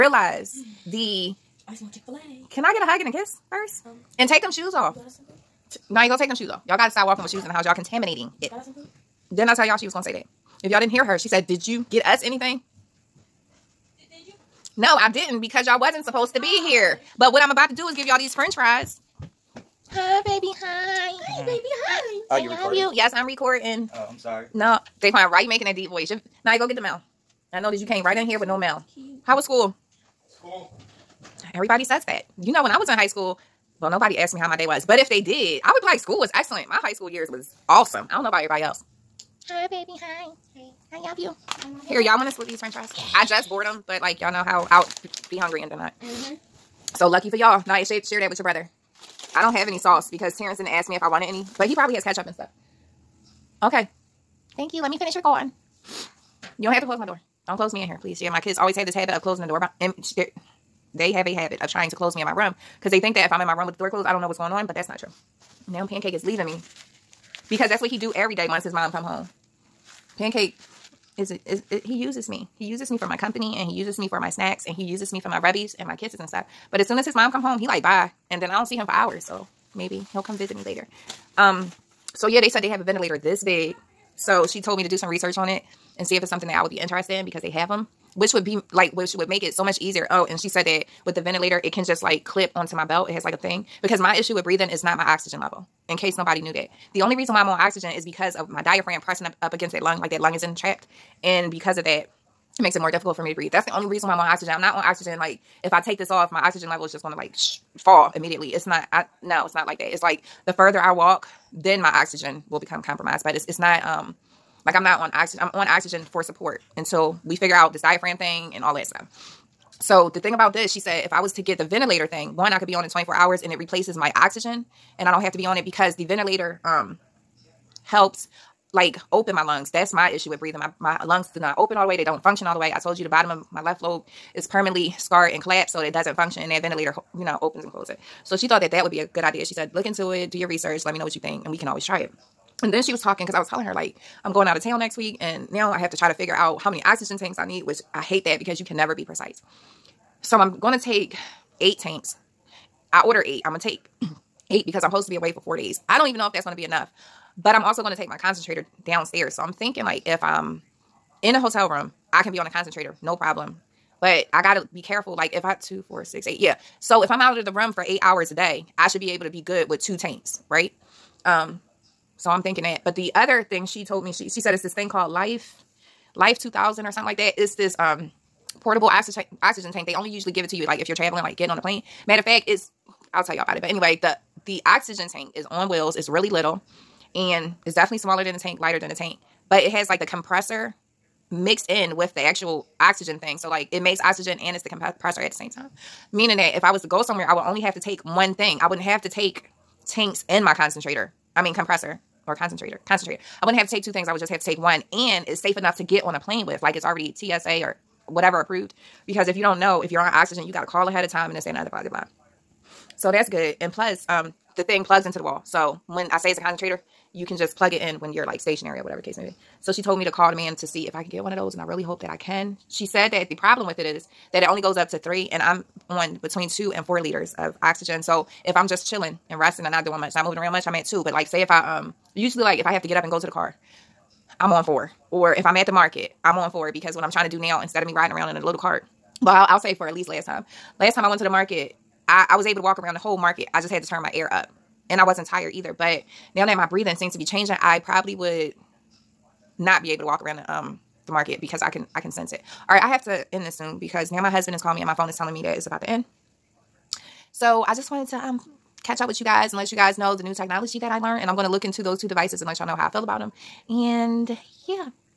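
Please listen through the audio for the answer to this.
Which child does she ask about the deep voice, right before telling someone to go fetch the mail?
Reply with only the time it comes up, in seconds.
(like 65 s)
24 s.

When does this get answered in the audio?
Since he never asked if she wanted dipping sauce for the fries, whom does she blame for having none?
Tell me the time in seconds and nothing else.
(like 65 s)
50 s.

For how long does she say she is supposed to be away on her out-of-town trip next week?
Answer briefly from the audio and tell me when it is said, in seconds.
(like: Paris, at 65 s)
4 days, at 155 s.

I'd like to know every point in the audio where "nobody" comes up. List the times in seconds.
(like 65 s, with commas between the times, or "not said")
33 s, 96 s.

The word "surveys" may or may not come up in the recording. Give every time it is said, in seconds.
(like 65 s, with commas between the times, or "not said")
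not said.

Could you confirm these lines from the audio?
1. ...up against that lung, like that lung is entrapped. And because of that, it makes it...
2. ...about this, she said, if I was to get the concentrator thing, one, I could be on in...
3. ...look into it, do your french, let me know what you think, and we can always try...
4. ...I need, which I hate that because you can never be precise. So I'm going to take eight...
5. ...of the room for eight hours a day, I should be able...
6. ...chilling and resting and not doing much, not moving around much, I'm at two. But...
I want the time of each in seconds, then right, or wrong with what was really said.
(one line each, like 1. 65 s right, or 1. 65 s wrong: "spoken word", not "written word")
1. 99 s right
2. 120 s wrong: "ventilator", not "concentrator"
3. 139 s wrong: "research", not "french"
4. 147 s right
5. 167 s right
6. 228 s right.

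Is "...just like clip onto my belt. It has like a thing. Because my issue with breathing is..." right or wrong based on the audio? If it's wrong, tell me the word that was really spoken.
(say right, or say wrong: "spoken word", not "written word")
right.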